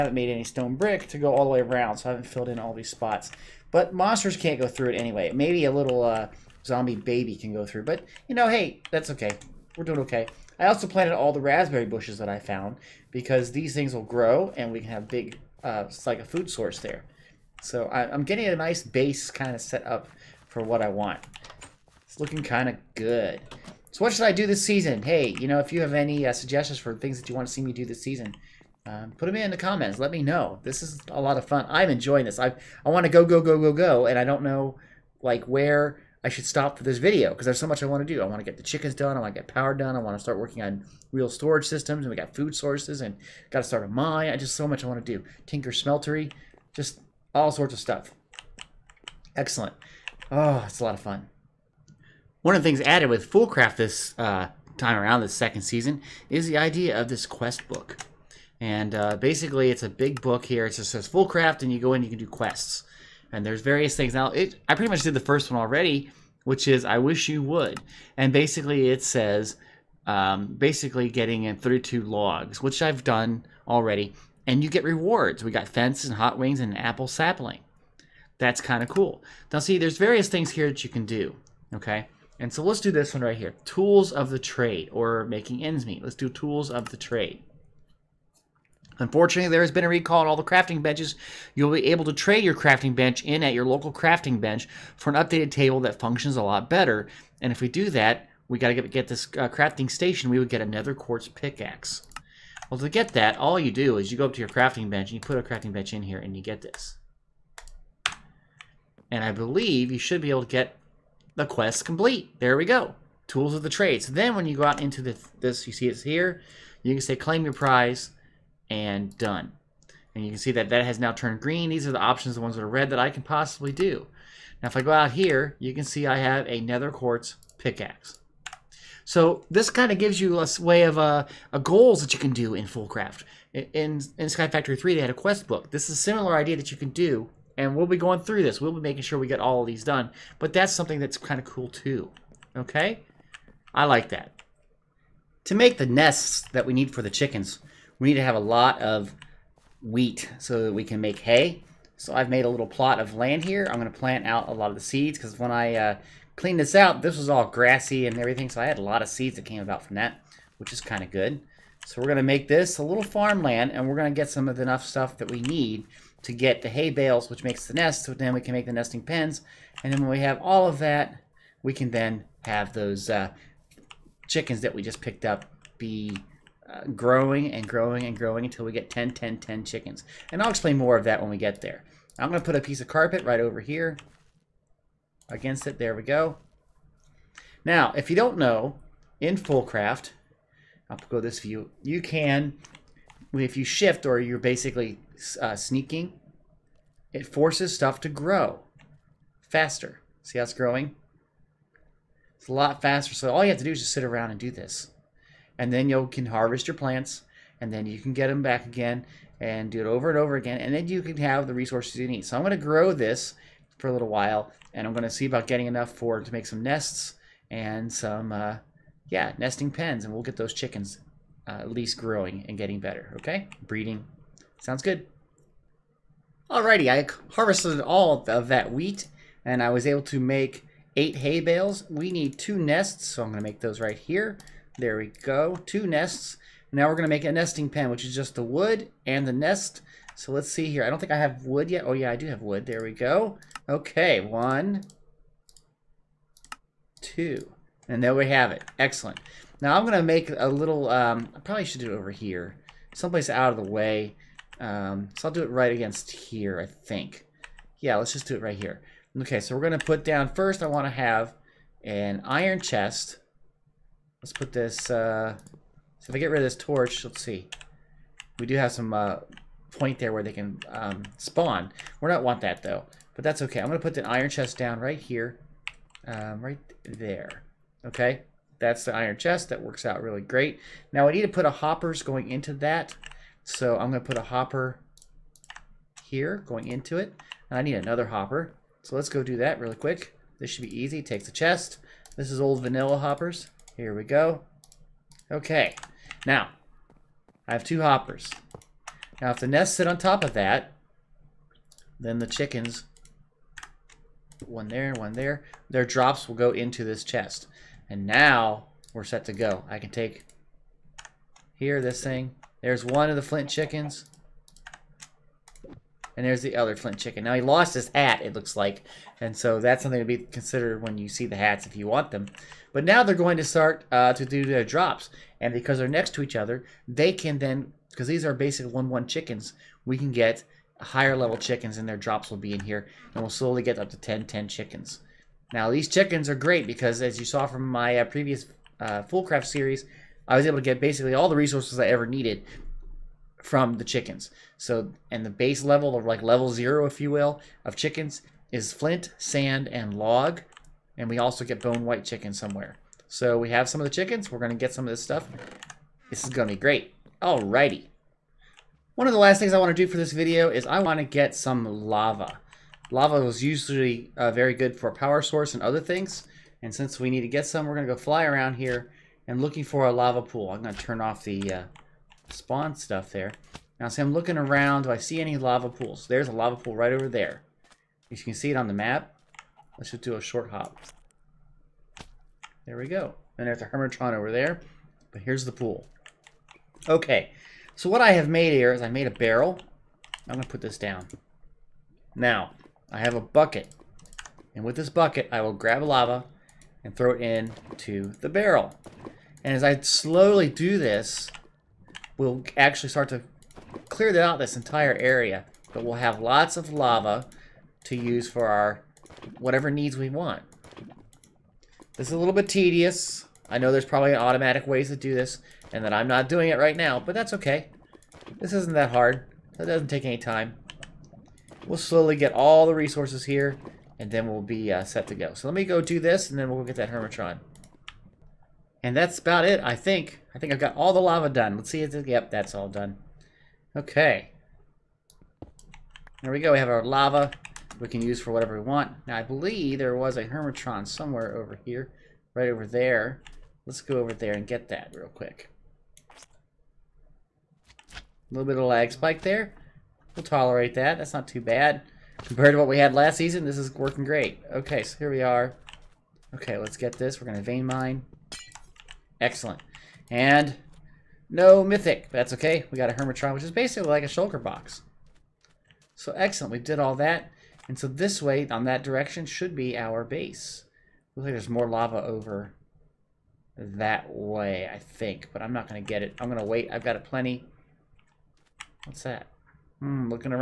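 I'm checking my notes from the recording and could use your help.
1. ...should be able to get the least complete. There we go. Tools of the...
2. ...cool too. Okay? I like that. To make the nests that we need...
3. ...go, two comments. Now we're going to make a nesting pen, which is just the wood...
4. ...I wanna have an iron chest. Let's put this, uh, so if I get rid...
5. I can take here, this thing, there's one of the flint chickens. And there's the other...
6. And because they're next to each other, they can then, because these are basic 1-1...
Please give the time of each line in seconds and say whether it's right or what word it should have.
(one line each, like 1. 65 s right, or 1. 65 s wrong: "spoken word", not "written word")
1. 109 s wrong: "quest", not "least"
2. 141 s right
3. 235 s wrong: "nests", not "comments"
4. 260 s right
5. 309 s right
6. 325 s right.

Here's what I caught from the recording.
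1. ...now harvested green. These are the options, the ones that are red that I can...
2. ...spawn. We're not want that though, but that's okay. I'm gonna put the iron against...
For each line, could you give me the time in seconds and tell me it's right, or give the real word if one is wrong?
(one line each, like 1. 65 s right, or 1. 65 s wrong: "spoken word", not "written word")
1. 120 s wrong: "turned", not "harvested"
2. 271 s wrong: "chest", not "against".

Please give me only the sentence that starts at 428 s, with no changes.
And that's about it, I think.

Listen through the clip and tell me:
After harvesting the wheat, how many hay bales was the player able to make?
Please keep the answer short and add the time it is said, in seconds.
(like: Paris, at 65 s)
8, at 230 s.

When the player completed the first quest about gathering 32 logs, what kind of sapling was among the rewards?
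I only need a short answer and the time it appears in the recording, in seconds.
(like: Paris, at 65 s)
Apple sapling, at 76 s.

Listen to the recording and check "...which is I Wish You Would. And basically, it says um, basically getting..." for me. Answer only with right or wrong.
right.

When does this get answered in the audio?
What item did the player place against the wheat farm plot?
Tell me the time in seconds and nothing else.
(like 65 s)
182 s.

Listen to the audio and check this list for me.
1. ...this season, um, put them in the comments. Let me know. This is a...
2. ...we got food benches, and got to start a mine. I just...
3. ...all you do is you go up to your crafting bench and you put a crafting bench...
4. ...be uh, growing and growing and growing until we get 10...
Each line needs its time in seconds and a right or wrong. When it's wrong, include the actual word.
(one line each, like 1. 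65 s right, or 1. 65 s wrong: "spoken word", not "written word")
1. 27 s right
2. 42 s wrong: "sources", not "benches"
3. 103 s right
4. 175 s right.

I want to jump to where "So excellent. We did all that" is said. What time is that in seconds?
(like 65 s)
465 s.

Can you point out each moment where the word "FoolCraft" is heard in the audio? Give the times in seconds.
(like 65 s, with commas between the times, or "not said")
53 s, 61 s, 132 s, 189 s, 339 s.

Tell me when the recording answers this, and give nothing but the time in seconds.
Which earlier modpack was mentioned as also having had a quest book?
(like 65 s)
134 s.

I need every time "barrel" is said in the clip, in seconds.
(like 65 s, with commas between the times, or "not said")
389 s, 398 s.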